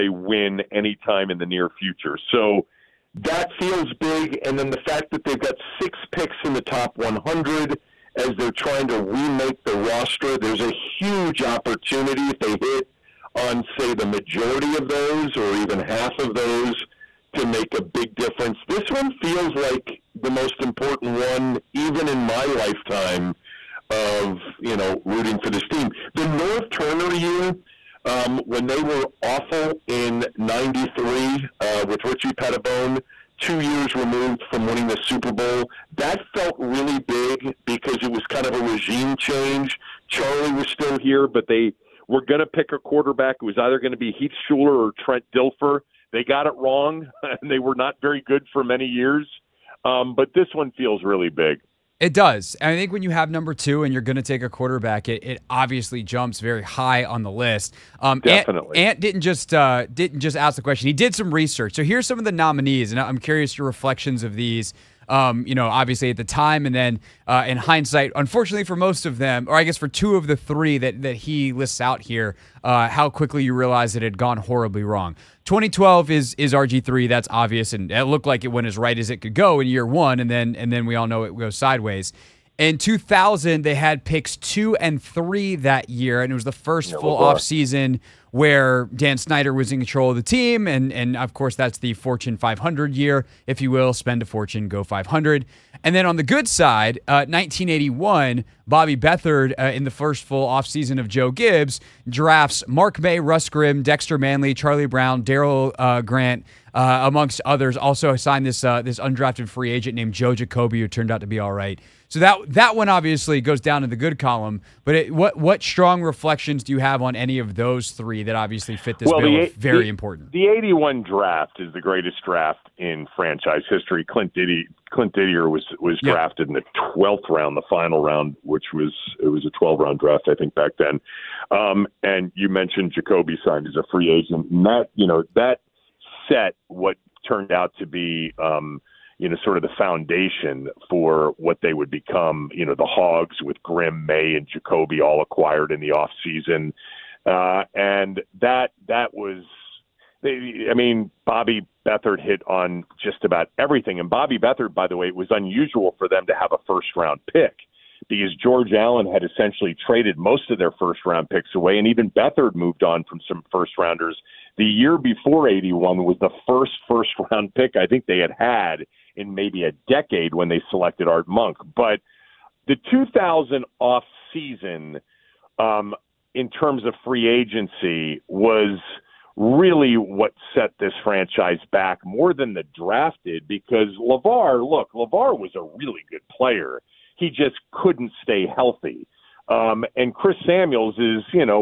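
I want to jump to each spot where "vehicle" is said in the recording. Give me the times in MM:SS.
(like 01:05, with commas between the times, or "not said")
not said.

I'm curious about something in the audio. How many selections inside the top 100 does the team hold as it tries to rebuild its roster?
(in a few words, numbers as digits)
6.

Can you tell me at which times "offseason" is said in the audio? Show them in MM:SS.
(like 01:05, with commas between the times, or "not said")
01:27, 01:40.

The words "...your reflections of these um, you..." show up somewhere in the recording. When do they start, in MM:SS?
01:03.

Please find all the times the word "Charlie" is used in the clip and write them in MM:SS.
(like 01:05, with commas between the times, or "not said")
00:40, 01:44.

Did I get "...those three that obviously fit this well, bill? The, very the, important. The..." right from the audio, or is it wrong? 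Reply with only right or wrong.
right.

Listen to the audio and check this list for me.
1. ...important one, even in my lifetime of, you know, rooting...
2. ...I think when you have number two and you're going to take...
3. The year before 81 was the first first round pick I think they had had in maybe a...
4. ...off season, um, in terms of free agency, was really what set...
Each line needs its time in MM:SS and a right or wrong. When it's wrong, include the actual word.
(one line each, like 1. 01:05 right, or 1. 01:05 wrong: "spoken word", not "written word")
1. 00:20 right
2. 00:52 right
3. 02:44 right
4. 02:53 right.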